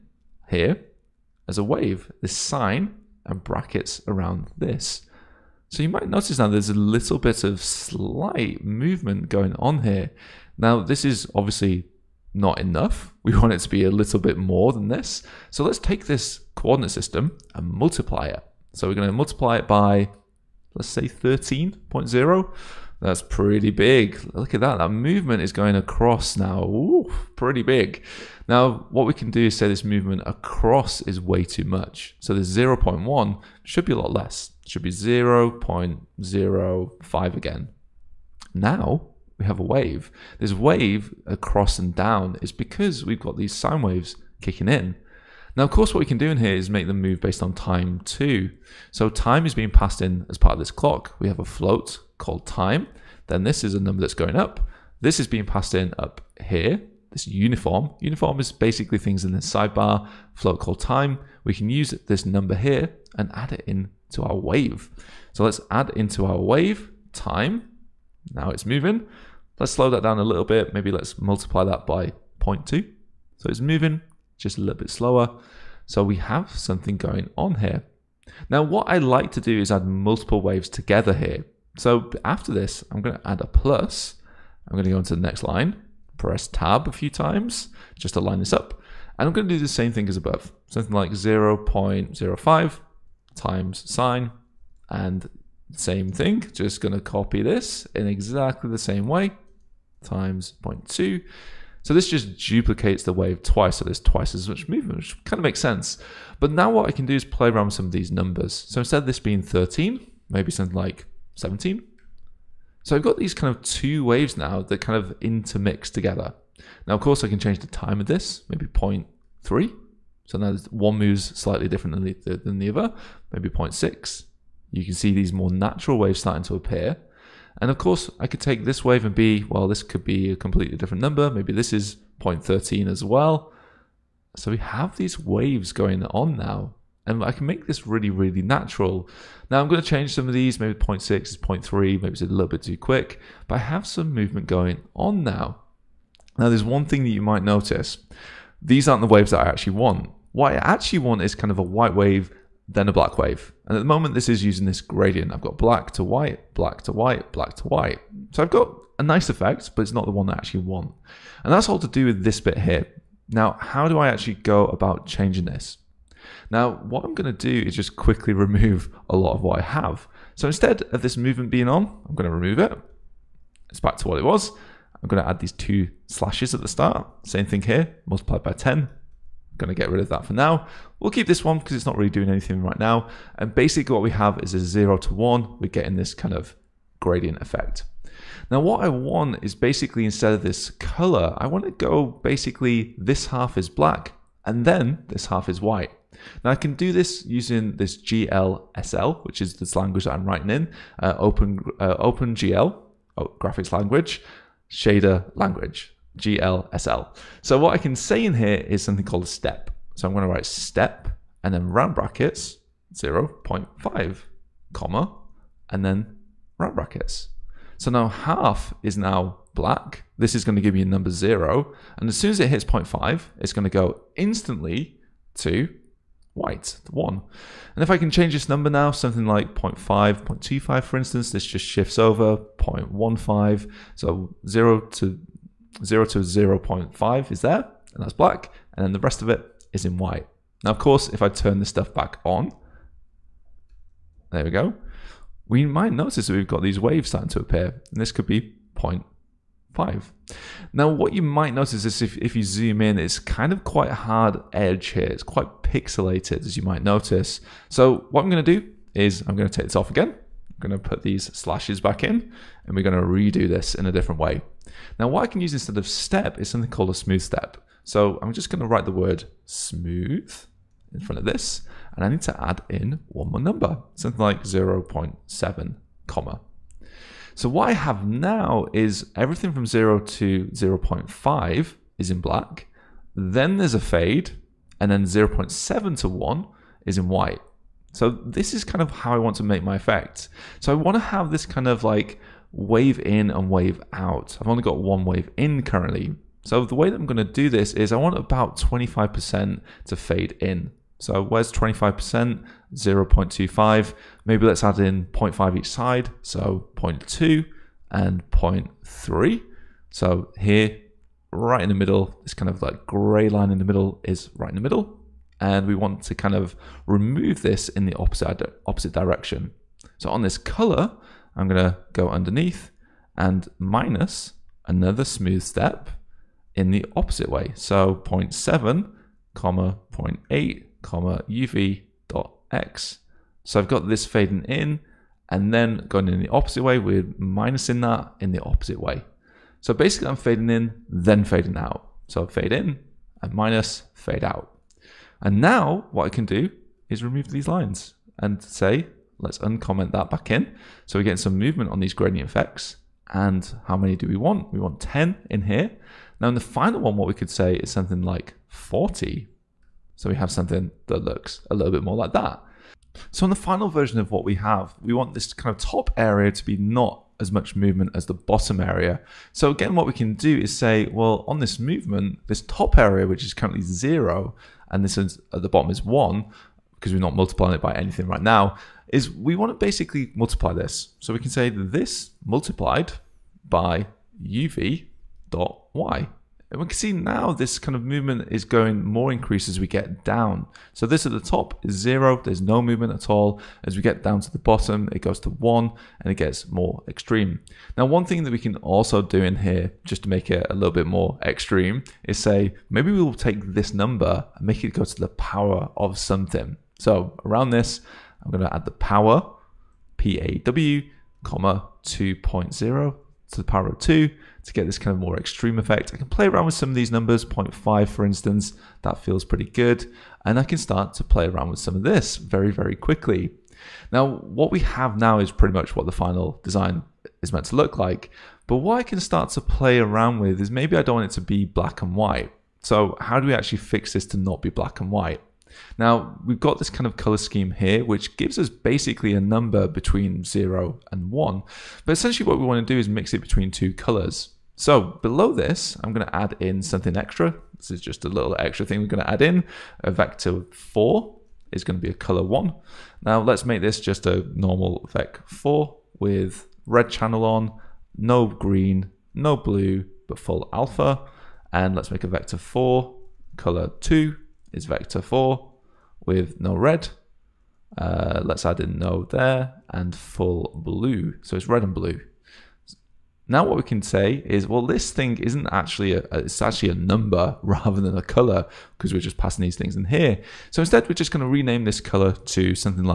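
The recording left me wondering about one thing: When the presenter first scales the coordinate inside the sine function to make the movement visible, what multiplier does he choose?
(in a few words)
13.0.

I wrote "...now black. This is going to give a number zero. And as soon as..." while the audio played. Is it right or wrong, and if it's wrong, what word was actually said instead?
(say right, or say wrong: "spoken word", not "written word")
right.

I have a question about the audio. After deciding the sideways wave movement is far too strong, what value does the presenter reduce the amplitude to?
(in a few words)
0.05.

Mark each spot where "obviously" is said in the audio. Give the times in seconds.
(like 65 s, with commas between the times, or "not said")
11 s.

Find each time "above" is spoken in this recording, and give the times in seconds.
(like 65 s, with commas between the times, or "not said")
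90 s.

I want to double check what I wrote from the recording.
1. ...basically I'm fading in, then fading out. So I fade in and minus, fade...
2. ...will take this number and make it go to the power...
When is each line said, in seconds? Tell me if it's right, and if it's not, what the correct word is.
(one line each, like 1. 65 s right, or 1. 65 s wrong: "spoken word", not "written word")
1. 339 s right
2. 403 s right.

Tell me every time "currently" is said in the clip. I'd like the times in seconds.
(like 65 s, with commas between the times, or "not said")
295 s, 373 s.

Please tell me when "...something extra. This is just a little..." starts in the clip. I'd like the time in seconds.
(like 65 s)
446 s.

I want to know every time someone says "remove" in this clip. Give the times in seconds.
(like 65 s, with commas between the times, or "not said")
168 s, 172 s, 316 s, 347 s.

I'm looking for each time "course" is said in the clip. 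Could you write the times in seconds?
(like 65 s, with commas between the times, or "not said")
45 s, 117 s, 127 s, 240 s.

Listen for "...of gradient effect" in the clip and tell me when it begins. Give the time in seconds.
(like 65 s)
186 s.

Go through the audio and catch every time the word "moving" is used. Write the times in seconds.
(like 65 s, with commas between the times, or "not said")
68 s, 73 s.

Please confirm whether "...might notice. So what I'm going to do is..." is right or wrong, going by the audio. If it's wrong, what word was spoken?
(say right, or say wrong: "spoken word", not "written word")
right.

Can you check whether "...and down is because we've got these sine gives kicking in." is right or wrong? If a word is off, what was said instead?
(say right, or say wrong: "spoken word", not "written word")
wrong: "waves", not "gives".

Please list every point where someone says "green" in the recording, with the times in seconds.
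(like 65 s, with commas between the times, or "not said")
458 s.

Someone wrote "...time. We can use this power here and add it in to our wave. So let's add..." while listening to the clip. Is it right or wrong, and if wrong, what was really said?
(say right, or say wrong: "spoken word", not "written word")
wrong: "number", not "power".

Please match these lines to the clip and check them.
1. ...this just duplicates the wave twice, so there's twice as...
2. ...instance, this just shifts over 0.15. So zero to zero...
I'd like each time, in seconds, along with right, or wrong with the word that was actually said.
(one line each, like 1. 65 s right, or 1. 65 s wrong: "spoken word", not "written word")
1. 101 s right
2. 230 s right.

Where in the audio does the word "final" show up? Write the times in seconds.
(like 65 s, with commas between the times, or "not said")
356 s, 363 s, 425 s.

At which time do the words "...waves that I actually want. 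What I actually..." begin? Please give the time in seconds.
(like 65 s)
149 s.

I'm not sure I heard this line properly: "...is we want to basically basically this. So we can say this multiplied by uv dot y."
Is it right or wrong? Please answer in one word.
wrong.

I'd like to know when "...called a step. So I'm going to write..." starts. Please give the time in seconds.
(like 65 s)
209 s.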